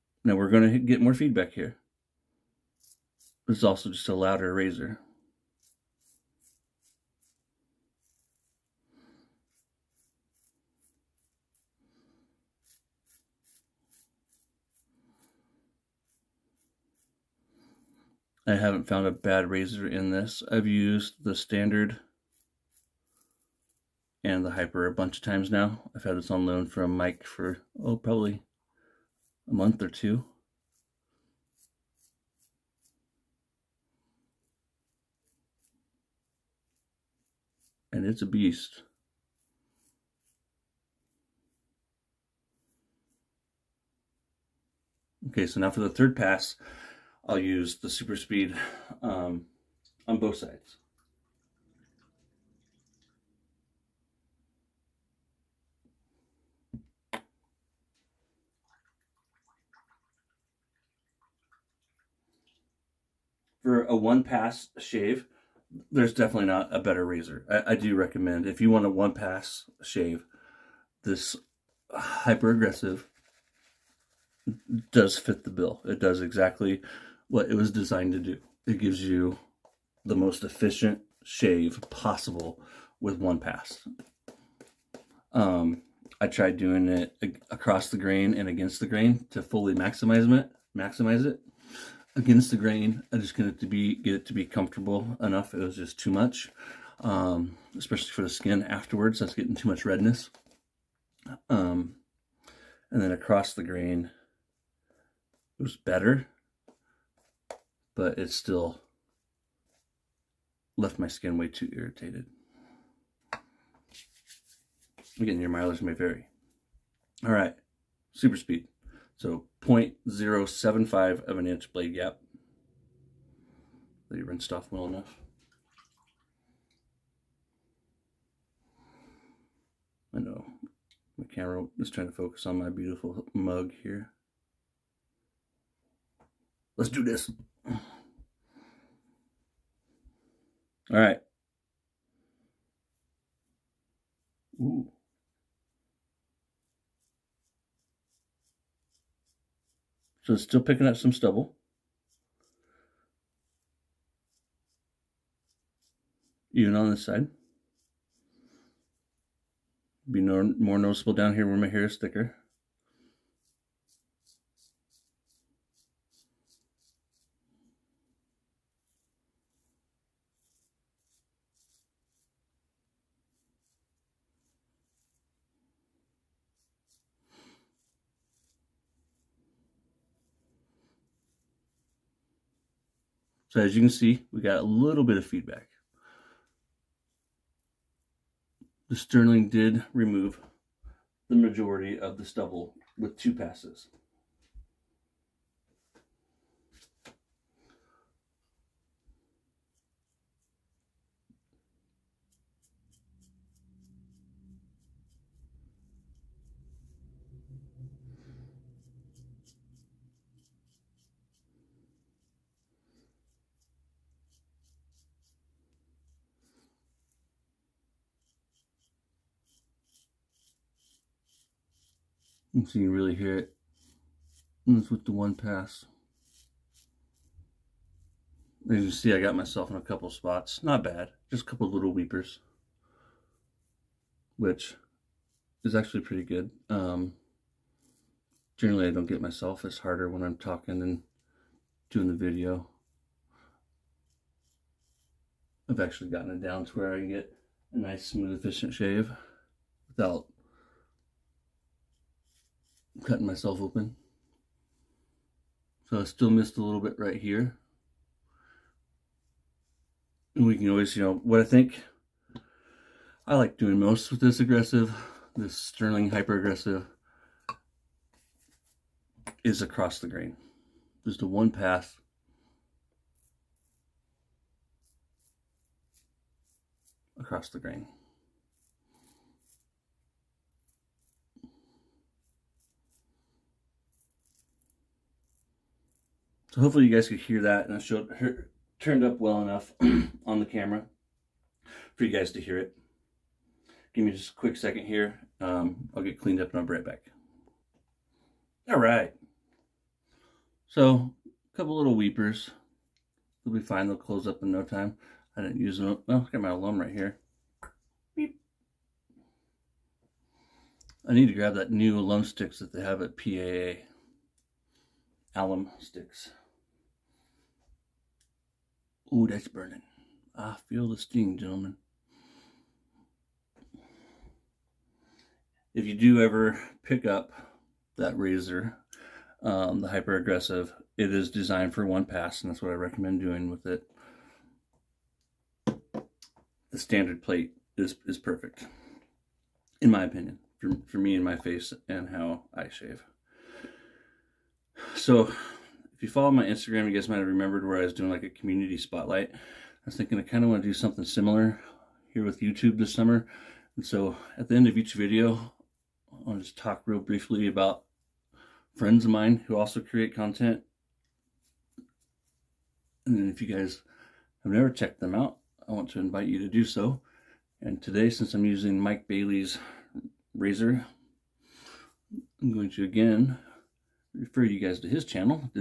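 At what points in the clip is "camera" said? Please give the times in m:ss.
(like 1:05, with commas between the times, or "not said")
2:11, 4:50.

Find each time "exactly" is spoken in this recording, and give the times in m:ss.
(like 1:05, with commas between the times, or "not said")
1:16.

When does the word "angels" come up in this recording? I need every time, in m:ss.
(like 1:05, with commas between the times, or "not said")
not said.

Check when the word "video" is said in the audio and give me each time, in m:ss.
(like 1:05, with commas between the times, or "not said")
4:02, 5:54.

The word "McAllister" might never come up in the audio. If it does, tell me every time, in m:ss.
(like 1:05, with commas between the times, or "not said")
not said.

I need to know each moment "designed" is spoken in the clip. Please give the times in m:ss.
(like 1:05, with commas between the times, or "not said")
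1:17, 5:31.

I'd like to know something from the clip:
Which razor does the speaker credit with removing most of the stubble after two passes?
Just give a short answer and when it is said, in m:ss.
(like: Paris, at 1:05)
The Sterling, at 3:08.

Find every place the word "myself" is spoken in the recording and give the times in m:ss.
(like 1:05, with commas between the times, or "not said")
3:49, 3:59, 4:13.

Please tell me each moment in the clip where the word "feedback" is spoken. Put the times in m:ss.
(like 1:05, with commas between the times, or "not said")
0:01, 3:05.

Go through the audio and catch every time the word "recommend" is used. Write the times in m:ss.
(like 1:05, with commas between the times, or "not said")
1:07, 5:32.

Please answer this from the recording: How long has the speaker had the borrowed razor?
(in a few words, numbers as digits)
a month or two.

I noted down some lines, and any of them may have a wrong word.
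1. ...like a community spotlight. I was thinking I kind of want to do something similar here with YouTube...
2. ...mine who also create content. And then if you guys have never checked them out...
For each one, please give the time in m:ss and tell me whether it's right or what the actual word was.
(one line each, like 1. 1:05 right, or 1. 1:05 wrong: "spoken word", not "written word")
1. 5:48 right
2. 5:59 right.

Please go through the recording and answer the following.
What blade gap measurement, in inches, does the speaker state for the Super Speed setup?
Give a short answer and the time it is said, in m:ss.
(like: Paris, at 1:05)
0.075, at 1:59.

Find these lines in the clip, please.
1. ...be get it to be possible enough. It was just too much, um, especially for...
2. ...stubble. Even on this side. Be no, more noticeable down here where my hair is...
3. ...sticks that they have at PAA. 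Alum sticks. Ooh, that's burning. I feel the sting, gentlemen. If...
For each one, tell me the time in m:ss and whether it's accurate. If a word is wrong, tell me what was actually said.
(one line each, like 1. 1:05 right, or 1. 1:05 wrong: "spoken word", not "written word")
1. 1:33 wrong: "comfortable", not "possible"
2. 2:31 right
3. 5:12 right.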